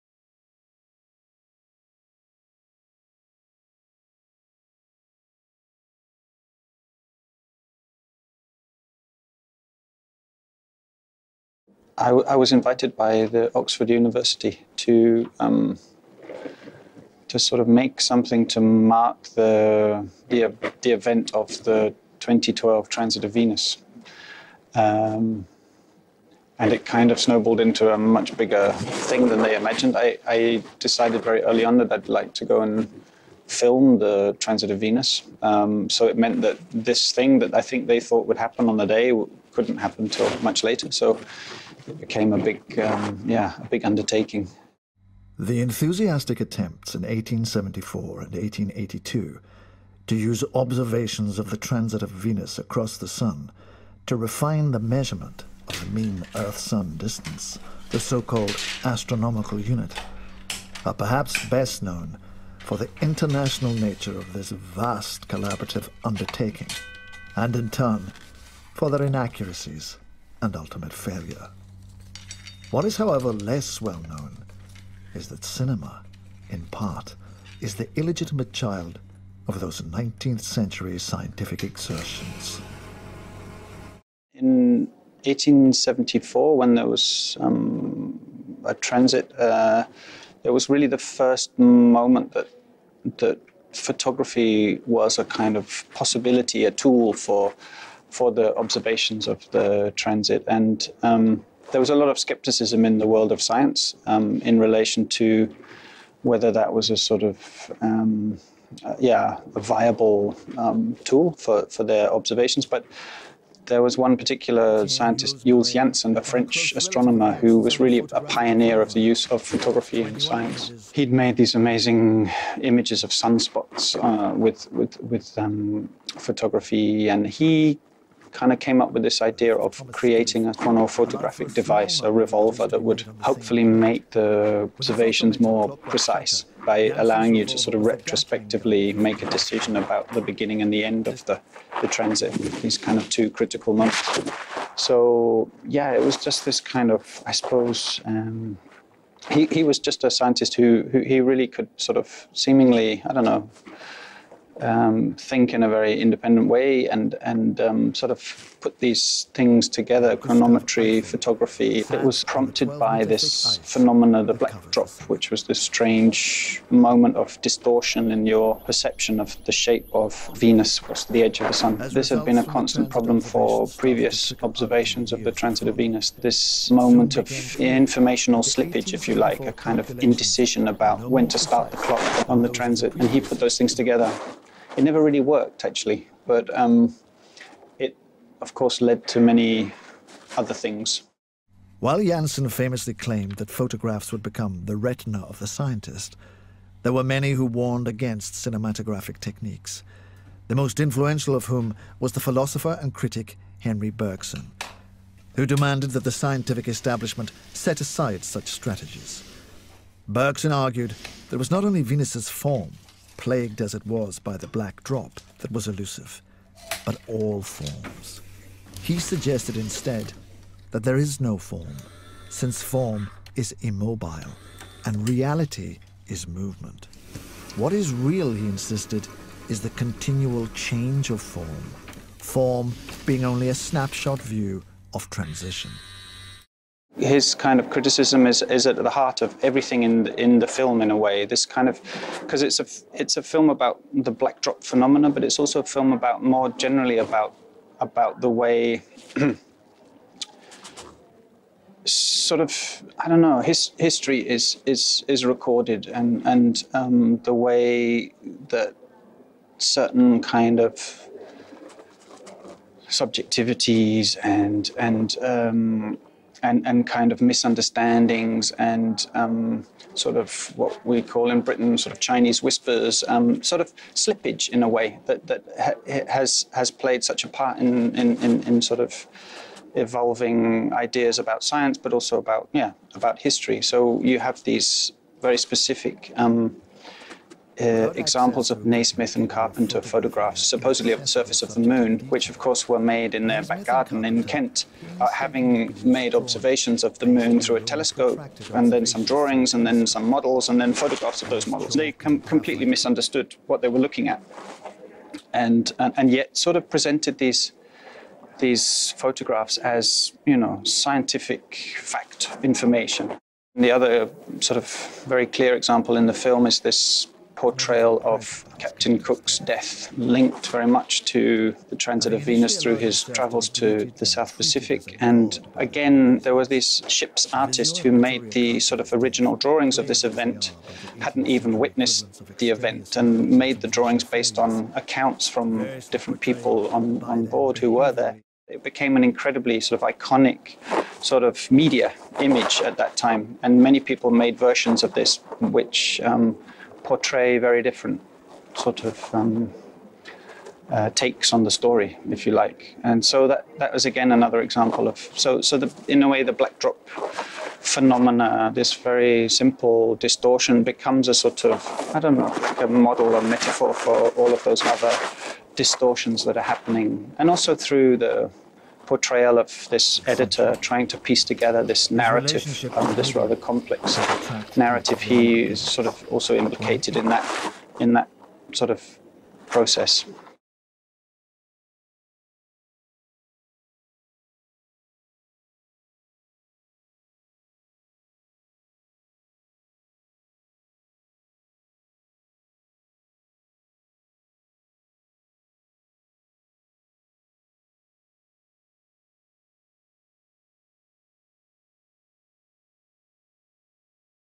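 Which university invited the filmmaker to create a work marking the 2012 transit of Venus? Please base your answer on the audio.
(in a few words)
Oxford University.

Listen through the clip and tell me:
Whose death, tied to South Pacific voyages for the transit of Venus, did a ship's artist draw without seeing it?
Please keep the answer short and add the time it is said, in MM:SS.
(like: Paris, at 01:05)
Captain Cook, at 05:18.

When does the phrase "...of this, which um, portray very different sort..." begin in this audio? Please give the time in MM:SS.
05:44.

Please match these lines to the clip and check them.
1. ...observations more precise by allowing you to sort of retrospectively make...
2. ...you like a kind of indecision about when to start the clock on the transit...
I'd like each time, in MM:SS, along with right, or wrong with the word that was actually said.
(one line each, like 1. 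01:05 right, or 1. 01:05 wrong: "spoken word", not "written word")
1. 02:14 right
2. 02:59 right.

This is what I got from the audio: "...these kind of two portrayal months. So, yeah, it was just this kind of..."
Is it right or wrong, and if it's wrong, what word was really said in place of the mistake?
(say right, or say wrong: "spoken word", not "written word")
wrong: "critical", not "portrayal".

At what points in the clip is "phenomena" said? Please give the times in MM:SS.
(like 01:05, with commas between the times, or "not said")
02:43, 04:04, 05:57.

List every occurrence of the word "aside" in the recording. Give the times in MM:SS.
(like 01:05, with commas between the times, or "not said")
03:27.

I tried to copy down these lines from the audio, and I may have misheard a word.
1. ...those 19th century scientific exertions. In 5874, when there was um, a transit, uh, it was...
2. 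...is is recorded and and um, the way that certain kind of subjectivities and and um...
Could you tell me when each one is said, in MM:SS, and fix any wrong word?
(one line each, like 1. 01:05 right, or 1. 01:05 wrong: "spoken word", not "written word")
1. 01:19 wrong: "1874", not "5874"
2. 04:14 right.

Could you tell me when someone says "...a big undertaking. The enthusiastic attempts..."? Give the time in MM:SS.
00:43.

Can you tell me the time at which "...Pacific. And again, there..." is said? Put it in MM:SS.
05:24.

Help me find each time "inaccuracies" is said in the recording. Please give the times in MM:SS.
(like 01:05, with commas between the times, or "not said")
01:09.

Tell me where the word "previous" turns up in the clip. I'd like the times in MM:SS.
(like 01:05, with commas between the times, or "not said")
02:53.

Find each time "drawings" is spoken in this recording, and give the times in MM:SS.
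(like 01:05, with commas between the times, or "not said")
04:59, 05:29, 05:33.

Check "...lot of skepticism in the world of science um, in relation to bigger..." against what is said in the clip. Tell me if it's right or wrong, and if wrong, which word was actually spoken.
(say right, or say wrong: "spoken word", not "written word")
wrong: "whether", not "bigger".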